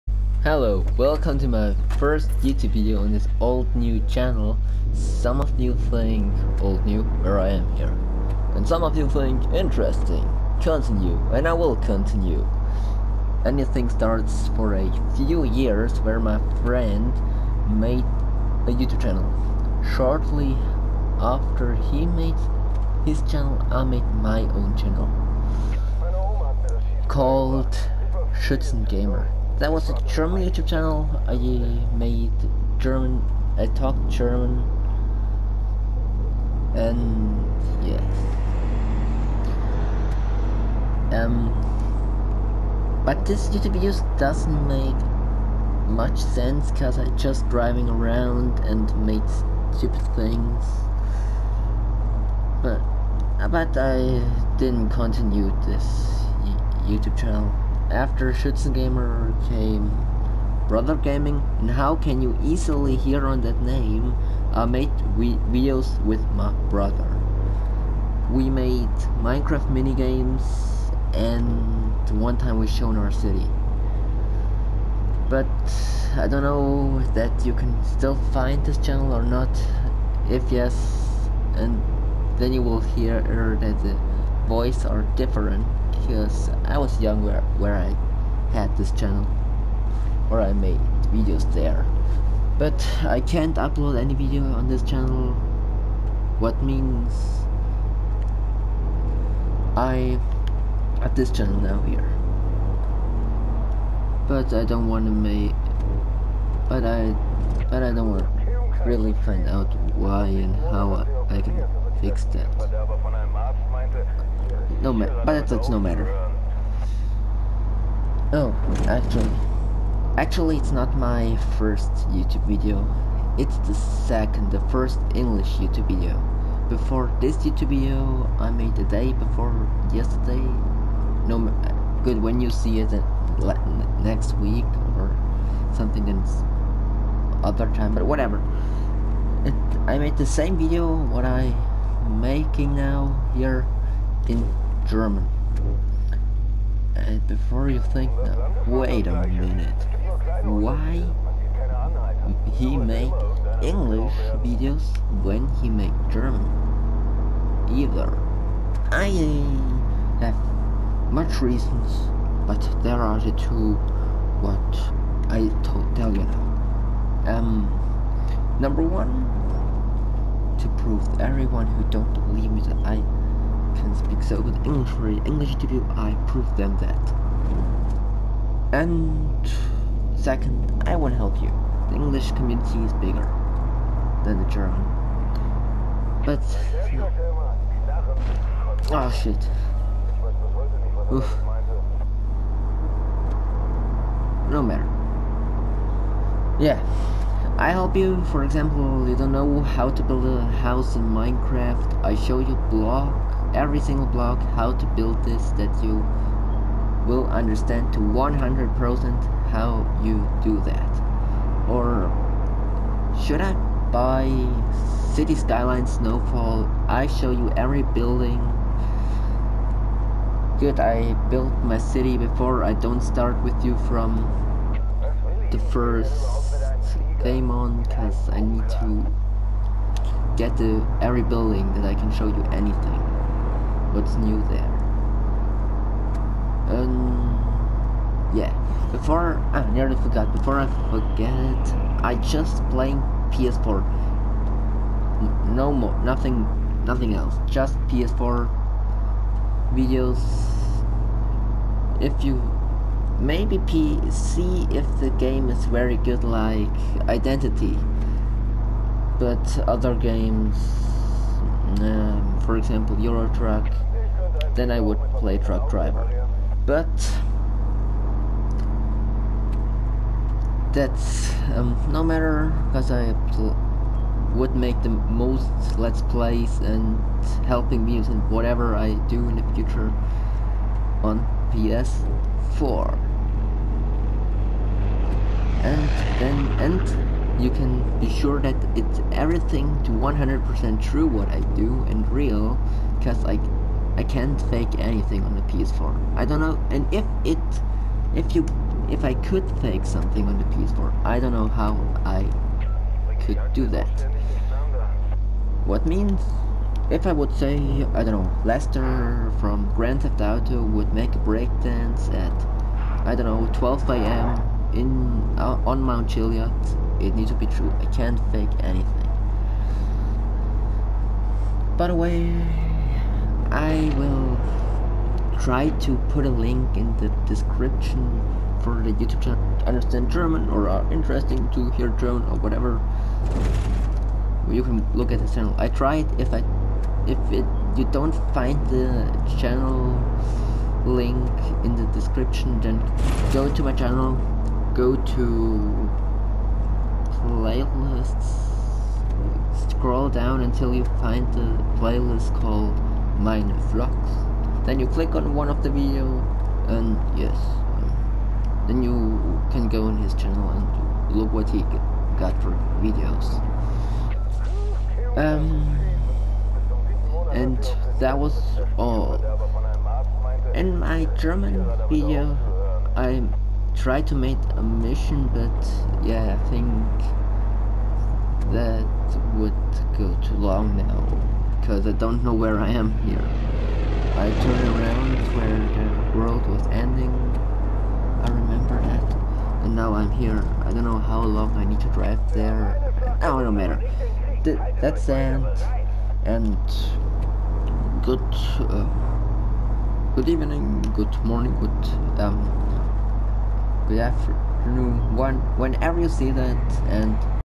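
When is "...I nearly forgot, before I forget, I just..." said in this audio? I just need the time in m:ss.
3:59.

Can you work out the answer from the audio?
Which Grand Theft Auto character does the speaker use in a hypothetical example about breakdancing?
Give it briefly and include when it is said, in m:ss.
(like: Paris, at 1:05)
Lester, at 5:08.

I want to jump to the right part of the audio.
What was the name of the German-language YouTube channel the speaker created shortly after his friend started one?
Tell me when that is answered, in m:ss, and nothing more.
0:28.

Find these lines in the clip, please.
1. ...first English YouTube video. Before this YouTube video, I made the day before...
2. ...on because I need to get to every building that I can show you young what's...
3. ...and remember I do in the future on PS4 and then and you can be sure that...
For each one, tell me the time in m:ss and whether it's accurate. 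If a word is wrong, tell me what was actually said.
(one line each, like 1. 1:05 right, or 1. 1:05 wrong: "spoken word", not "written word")
1. 2:04 right
2. 3:47 wrong: "anything", not "young"
3. 4:37 wrong: "whatever", not "remember".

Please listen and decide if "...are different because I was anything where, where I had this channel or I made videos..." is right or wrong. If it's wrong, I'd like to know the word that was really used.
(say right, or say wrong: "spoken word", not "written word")
wrong: "young", not "anything".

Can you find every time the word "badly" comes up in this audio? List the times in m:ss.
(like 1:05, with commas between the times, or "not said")
not said.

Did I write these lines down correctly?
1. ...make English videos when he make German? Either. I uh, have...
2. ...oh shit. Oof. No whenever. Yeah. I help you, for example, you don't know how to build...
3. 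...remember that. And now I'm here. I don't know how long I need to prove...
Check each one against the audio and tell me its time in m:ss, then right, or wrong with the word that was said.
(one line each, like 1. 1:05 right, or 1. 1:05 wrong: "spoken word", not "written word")
1. 2:32 right
2. 3:08 wrong: "matter", not "whenever"
3. 6:28 wrong: "drive", not "prove".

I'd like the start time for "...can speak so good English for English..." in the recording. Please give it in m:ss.
2:53.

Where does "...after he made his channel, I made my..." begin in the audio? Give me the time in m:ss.
0:21.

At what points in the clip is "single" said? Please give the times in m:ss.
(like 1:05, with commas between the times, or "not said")
3:23.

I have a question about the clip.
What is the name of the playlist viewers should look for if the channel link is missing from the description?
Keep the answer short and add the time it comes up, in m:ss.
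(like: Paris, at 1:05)
mine vlogs, at 5:53.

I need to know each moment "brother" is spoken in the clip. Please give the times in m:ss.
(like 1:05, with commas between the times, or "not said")
1:00, 1:06.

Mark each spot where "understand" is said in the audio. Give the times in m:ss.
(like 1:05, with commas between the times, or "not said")
3:27, 5:29.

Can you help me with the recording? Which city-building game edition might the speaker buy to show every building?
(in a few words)
City Skyline Snowfall.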